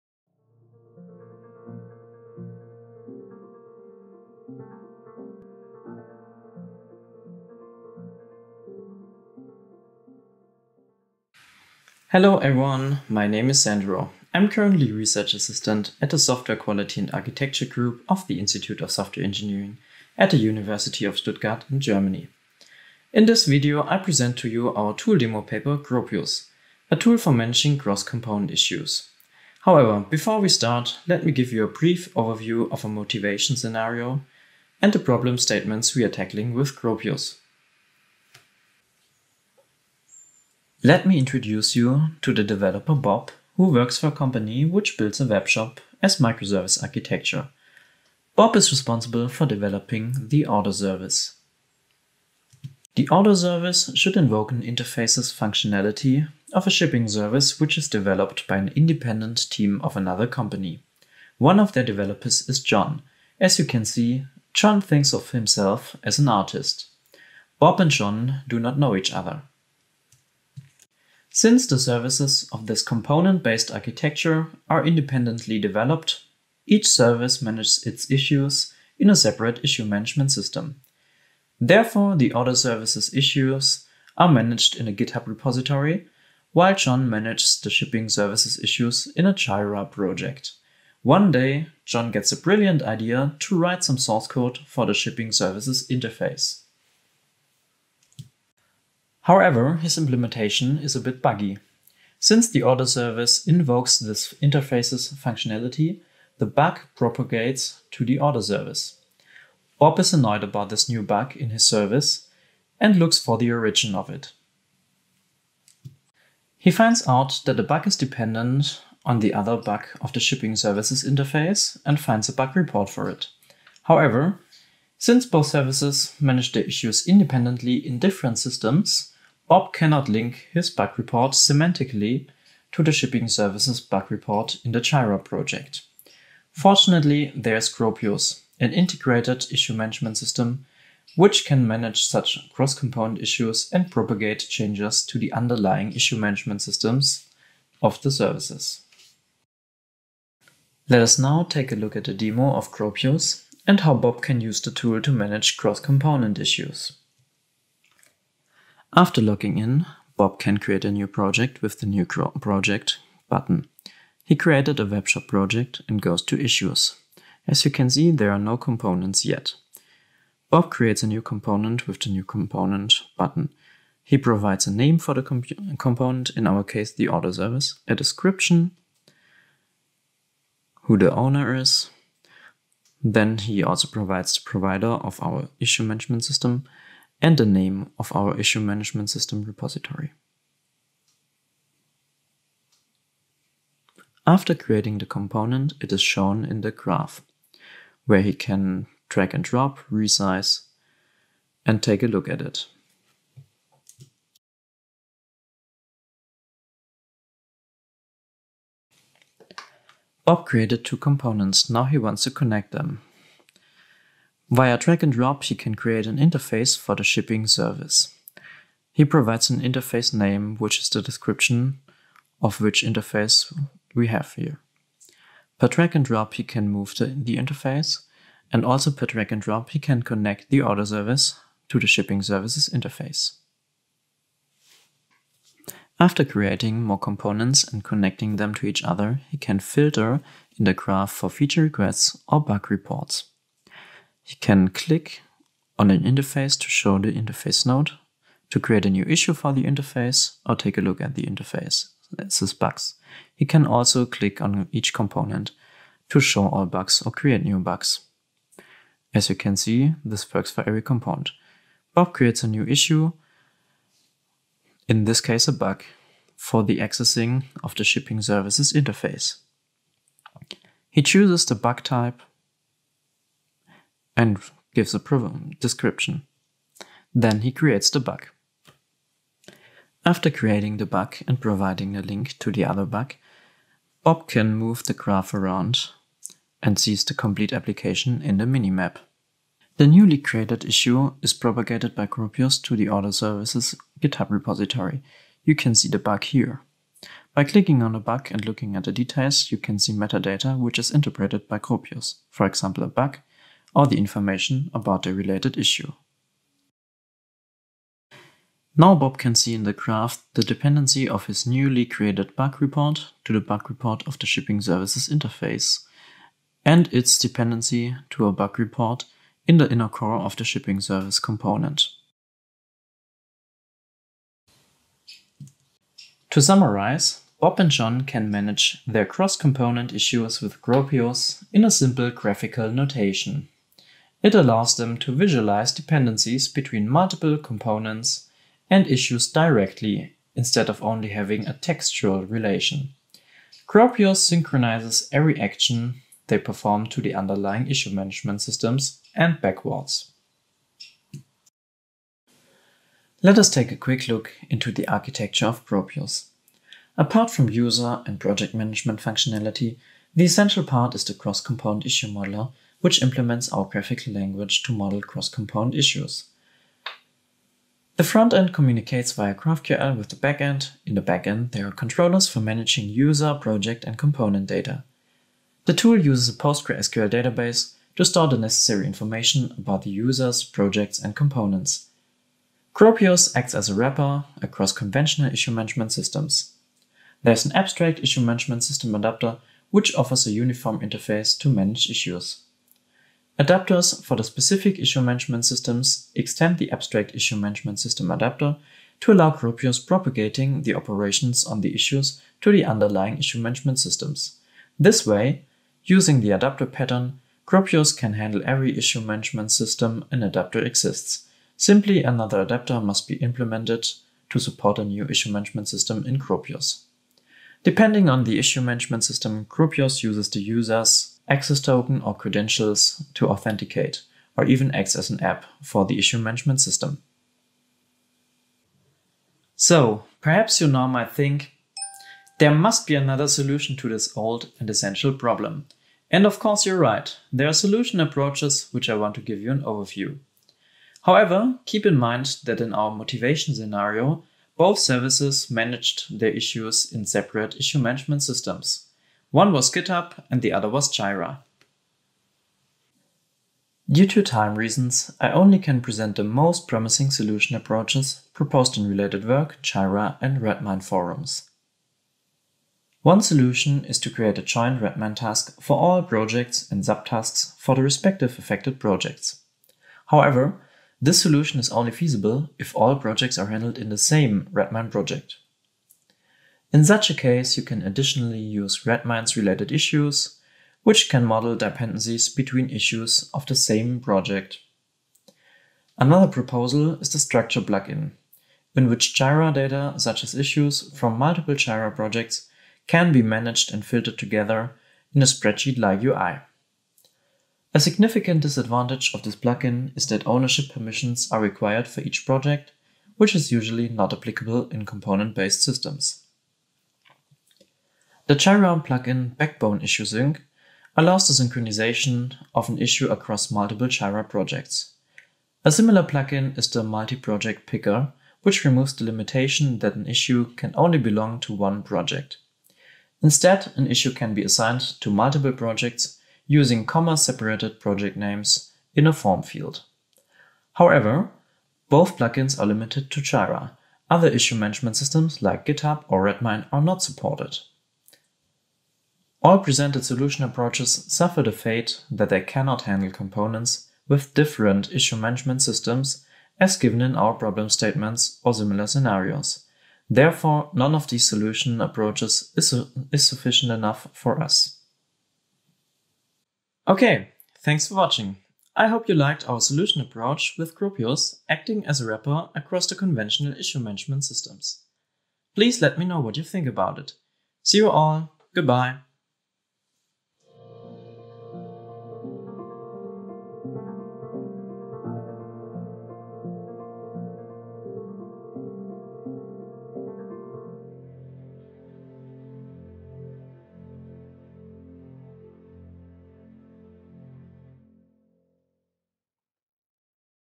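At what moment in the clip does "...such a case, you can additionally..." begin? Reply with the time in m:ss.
7:56.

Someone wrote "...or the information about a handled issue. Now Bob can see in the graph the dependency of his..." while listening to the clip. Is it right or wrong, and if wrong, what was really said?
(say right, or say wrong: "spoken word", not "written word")
wrong: "related", not "handled".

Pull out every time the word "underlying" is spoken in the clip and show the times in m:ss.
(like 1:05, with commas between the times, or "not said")
2:25, 5:47, 6:42.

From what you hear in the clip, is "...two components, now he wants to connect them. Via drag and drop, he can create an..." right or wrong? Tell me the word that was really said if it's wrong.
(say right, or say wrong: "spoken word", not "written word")
right.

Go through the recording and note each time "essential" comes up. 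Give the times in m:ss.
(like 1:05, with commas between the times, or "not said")
6:00, 7:14.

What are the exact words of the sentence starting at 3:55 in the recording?
After creating more components and connecting them to each other, he can filter in the graph for feature requests or bug reports.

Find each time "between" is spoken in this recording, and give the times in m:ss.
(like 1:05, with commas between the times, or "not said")
5:36, 8:02.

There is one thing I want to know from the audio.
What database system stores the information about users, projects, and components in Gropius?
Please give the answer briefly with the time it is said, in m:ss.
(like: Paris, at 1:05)
PostgreSQL, at 6:16.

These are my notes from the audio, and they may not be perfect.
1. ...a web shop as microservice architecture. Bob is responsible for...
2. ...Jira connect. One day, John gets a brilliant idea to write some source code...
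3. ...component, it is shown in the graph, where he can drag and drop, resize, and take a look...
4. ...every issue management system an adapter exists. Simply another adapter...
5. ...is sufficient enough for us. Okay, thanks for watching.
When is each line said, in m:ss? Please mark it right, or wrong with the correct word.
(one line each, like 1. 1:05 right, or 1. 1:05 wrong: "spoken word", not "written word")
1. 0:45 right
2. 1:29 wrong: "project", not "connect"
3. 3:15 right
4. 6:48 right
5. 9:13 right.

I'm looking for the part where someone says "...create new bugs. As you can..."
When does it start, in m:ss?
4:17.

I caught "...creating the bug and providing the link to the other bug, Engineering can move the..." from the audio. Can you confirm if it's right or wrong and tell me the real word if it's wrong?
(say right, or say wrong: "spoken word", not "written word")
wrong: "Bob", not "Engineering".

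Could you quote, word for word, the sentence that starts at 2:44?
He created a webshop project and goes to Issues.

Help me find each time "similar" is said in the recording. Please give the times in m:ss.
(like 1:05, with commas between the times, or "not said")
8:35, 9:08.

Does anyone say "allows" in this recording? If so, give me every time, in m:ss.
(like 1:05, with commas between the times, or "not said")
5:34, 6:39, 8:30.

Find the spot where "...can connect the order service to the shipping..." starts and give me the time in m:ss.
3:49.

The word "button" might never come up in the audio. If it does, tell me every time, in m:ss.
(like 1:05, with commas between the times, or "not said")
2:43, 2:53.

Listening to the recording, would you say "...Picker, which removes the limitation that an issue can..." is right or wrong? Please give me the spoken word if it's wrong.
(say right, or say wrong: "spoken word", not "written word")
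right.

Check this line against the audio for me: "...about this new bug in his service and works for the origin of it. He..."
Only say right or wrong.
wrong.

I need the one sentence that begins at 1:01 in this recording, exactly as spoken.
One of their developers is John.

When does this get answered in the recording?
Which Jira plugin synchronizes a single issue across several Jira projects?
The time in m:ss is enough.
8:29.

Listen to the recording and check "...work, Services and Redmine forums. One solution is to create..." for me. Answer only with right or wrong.
wrong.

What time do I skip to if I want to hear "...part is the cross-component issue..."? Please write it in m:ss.
6:00.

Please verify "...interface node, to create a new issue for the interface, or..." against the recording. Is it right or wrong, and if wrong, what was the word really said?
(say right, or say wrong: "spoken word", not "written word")
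right.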